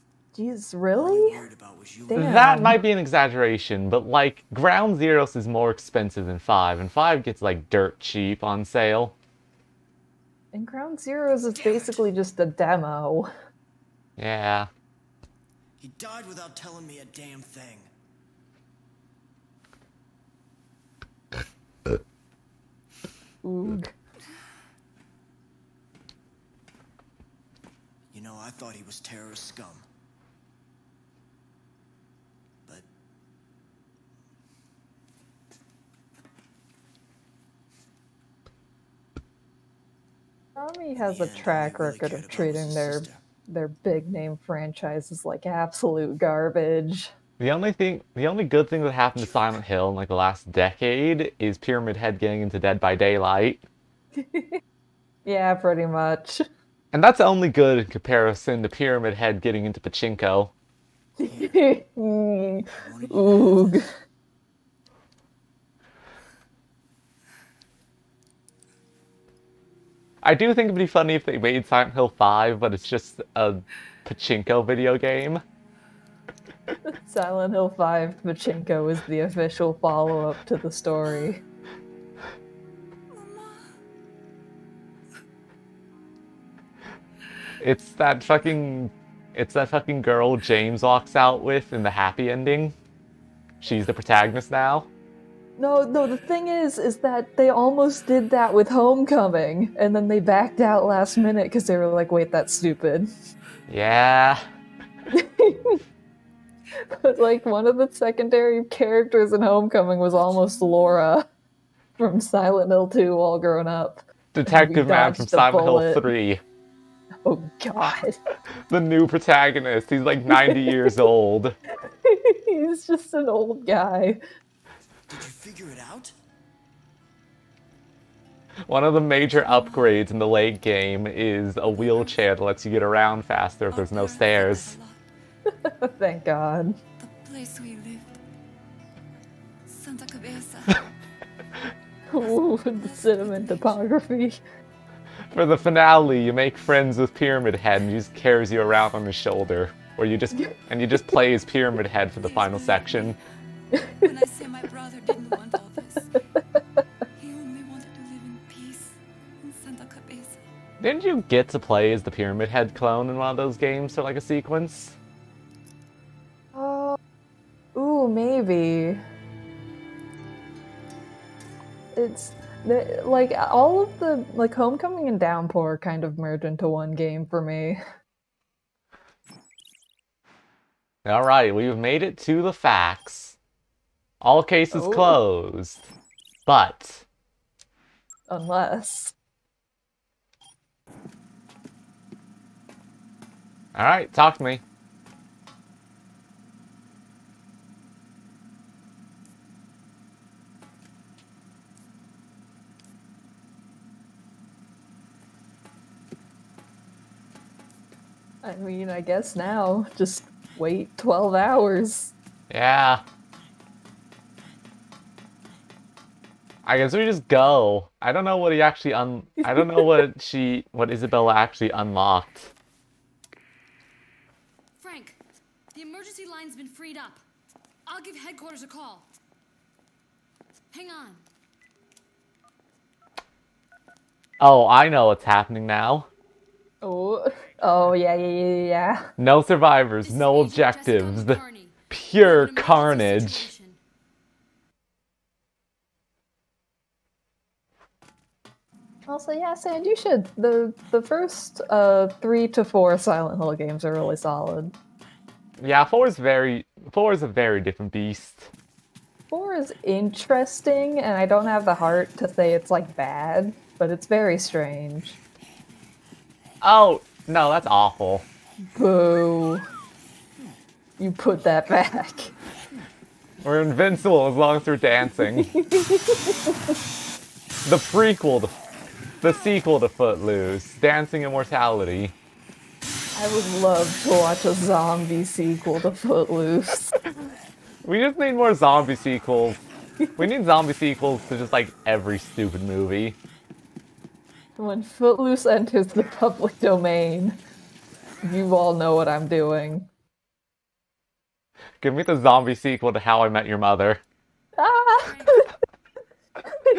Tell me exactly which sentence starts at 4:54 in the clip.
When Footloose enters the public domain, you all know what I'm doing.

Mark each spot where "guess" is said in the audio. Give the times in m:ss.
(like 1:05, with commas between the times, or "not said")
3:28, 3:36.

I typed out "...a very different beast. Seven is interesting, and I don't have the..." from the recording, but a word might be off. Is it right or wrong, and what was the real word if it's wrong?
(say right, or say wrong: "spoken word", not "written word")
wrong: "Four", not "Seven".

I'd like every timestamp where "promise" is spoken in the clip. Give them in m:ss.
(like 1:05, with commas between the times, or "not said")
not said.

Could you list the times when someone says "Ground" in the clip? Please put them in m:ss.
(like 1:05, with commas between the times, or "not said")
0:04, 0:10.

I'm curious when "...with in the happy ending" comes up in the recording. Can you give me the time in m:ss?
1:31.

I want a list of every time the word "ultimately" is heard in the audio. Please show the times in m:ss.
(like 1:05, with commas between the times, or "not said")
not said.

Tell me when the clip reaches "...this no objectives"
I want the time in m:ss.
4:00.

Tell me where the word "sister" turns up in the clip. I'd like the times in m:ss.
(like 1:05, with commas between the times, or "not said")
0:42.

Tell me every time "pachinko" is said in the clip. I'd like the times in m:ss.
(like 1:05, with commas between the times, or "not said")
0:59, 1:14, 1:18.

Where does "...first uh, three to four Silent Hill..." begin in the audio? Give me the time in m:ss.
4:11.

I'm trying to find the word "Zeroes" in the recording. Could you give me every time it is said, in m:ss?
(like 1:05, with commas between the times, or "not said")
0:04, 0:10.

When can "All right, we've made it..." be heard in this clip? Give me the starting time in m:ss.
3:01.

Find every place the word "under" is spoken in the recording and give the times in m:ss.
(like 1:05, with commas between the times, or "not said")
not said.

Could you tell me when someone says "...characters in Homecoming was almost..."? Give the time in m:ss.
1:48.